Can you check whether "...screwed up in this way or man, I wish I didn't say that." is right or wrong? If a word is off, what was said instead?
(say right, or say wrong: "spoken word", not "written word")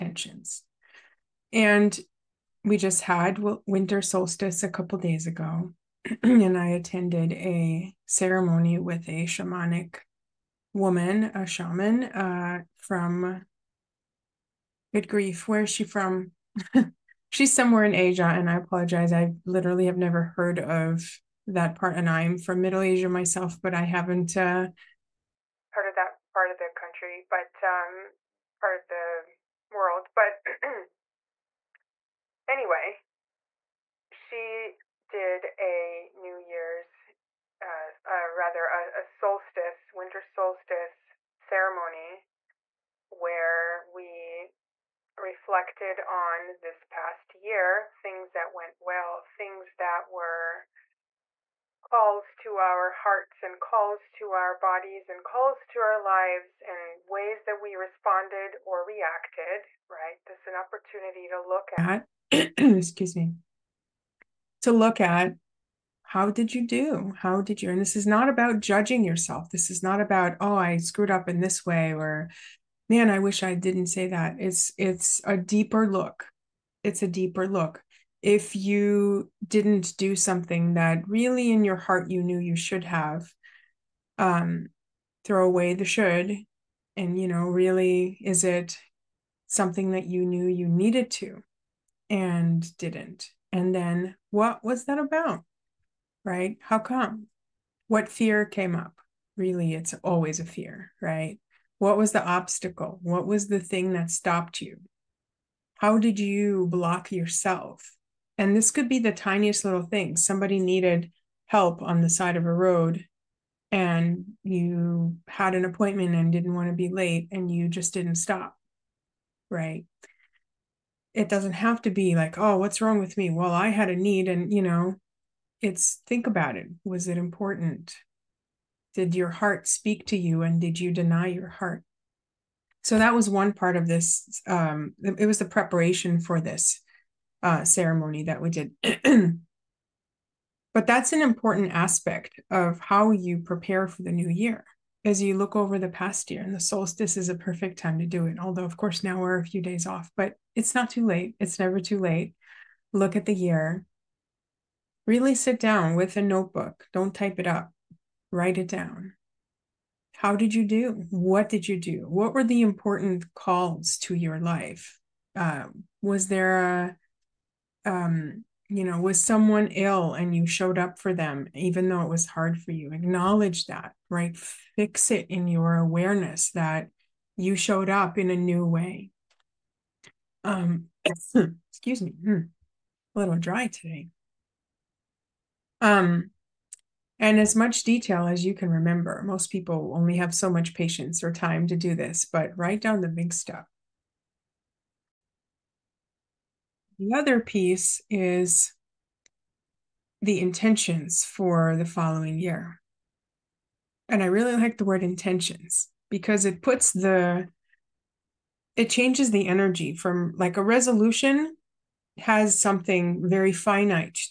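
right.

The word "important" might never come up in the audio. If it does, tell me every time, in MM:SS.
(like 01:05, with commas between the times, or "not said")
02:07, 02:21, 02:42.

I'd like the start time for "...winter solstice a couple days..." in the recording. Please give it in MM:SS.
00:03.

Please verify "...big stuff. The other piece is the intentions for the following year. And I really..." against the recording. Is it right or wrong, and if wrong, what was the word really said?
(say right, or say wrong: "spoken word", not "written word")
right.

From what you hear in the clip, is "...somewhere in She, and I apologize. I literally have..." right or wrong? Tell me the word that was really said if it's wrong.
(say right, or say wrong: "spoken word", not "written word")
wrong: "Asia", not "She".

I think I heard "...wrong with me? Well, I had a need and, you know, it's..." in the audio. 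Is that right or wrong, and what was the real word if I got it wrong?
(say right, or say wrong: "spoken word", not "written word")
right.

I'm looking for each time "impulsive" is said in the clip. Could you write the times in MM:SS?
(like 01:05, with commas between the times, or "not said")
not said.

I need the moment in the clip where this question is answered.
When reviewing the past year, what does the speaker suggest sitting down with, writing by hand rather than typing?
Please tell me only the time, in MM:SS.
02:36.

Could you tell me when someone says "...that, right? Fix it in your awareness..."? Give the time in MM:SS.
02:53.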